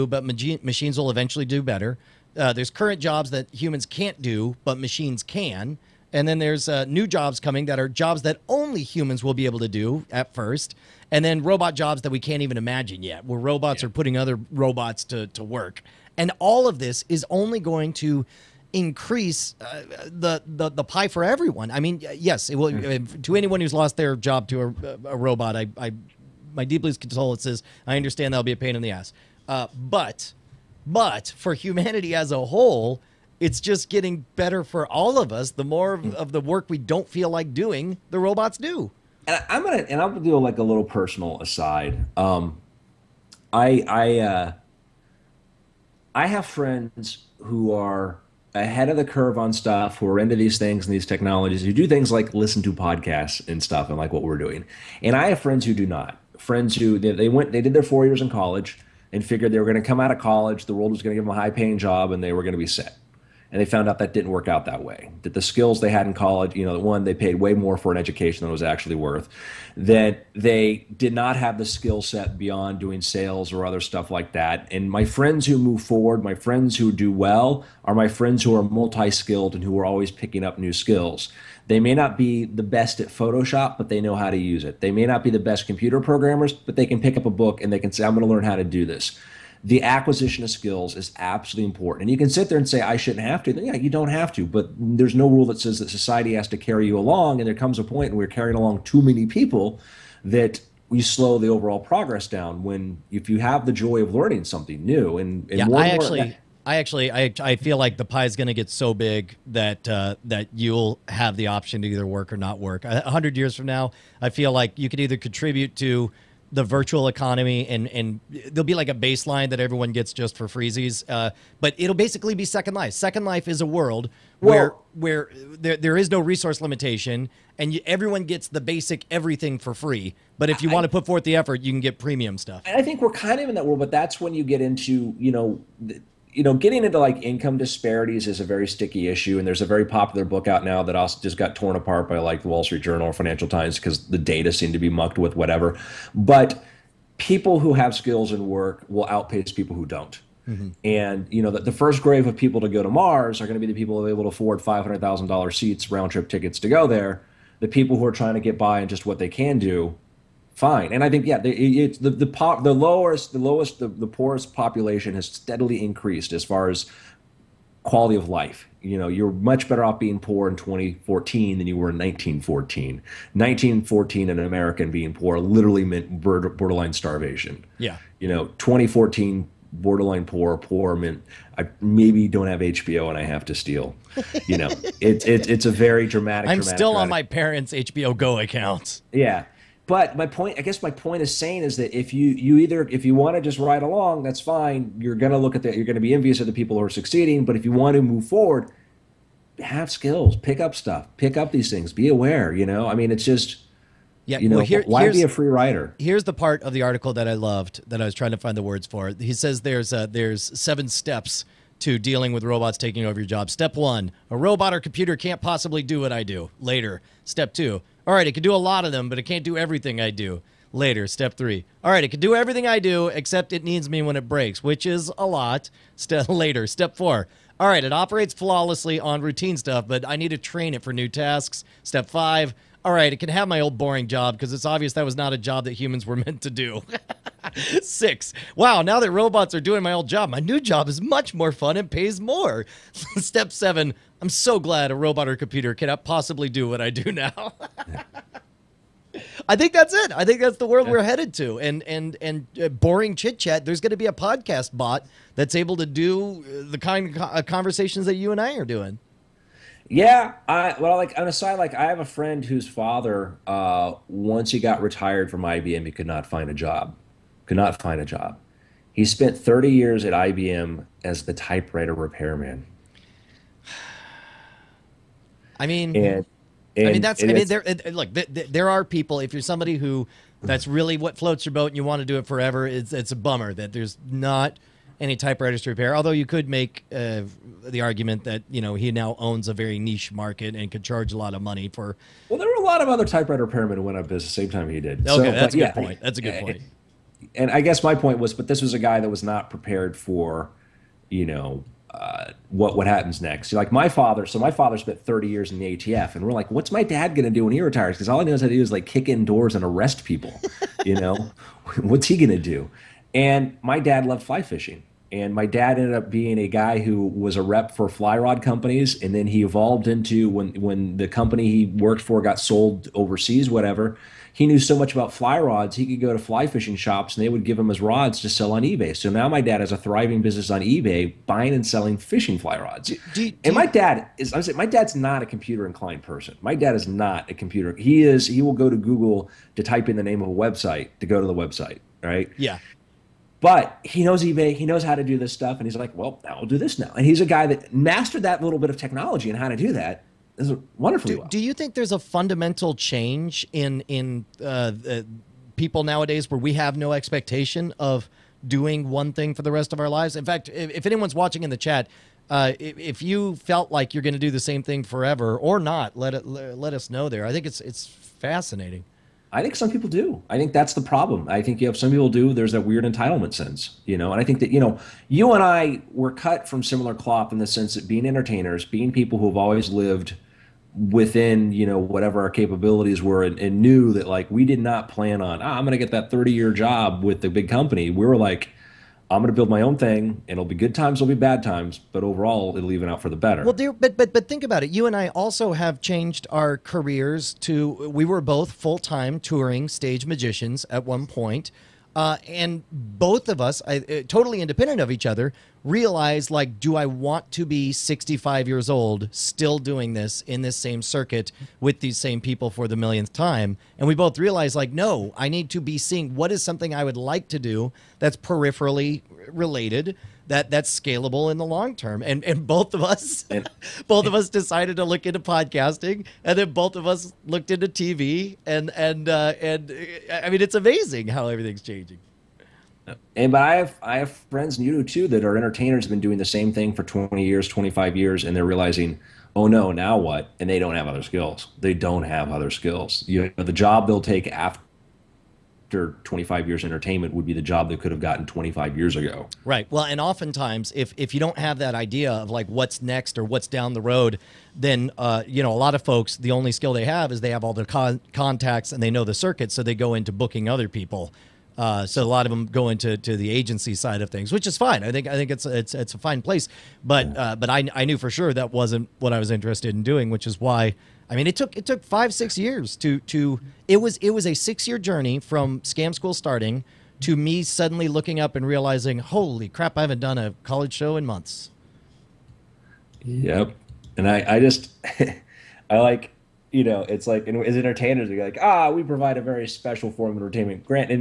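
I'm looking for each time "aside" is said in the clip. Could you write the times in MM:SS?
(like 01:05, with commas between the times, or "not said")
00:41.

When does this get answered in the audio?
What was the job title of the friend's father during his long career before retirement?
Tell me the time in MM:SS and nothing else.
04:31.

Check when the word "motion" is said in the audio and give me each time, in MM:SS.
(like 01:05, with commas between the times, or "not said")
not said.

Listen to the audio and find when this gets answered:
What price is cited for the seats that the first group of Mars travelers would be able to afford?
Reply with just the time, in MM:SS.
02:34.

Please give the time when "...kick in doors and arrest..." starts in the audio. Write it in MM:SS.
05:08.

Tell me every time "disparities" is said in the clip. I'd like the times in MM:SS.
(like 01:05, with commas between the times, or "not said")
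02:17.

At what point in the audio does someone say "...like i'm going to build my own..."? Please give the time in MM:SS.
06:28.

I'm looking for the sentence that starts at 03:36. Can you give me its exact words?
Later, step two: all right, it can do a lot of them, but it can't do everything I do.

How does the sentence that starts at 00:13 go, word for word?
are putting other robots to, to work.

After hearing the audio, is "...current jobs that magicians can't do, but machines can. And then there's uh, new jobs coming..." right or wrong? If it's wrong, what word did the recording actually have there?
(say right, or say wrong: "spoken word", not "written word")
wrong: "humans", not "magicians".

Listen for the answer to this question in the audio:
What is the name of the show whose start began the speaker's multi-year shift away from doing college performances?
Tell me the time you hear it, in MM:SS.
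07:55.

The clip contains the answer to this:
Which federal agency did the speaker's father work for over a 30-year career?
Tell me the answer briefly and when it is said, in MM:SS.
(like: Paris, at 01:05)
ATF, at 05:05.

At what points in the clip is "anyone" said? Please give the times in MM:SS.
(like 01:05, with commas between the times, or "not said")
00:23, 06:00.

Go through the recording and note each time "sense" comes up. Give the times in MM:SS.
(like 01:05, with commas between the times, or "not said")
06:13, 06:17.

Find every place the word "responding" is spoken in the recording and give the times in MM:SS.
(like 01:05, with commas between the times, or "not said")
not said.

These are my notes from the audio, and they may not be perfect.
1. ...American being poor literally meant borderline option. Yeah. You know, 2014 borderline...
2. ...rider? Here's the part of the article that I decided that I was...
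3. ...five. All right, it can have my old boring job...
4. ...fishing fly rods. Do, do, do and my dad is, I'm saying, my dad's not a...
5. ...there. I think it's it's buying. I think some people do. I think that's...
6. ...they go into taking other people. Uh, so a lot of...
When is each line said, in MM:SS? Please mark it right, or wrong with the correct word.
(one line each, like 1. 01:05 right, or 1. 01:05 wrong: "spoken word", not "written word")
1. 02:54 wrong: "starvation", not "option"
2. 03:25 wrong: "loved", not "decided"
3. 03:52 right
4. 05:31 right
5. 06:07 wrong: "fascinating", not "buying"
6. 07:39 wrong: "booking", not "taking".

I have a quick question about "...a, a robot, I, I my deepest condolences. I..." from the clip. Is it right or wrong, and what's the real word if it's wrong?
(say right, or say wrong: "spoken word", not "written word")
right.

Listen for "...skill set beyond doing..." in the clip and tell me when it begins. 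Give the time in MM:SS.
01:11.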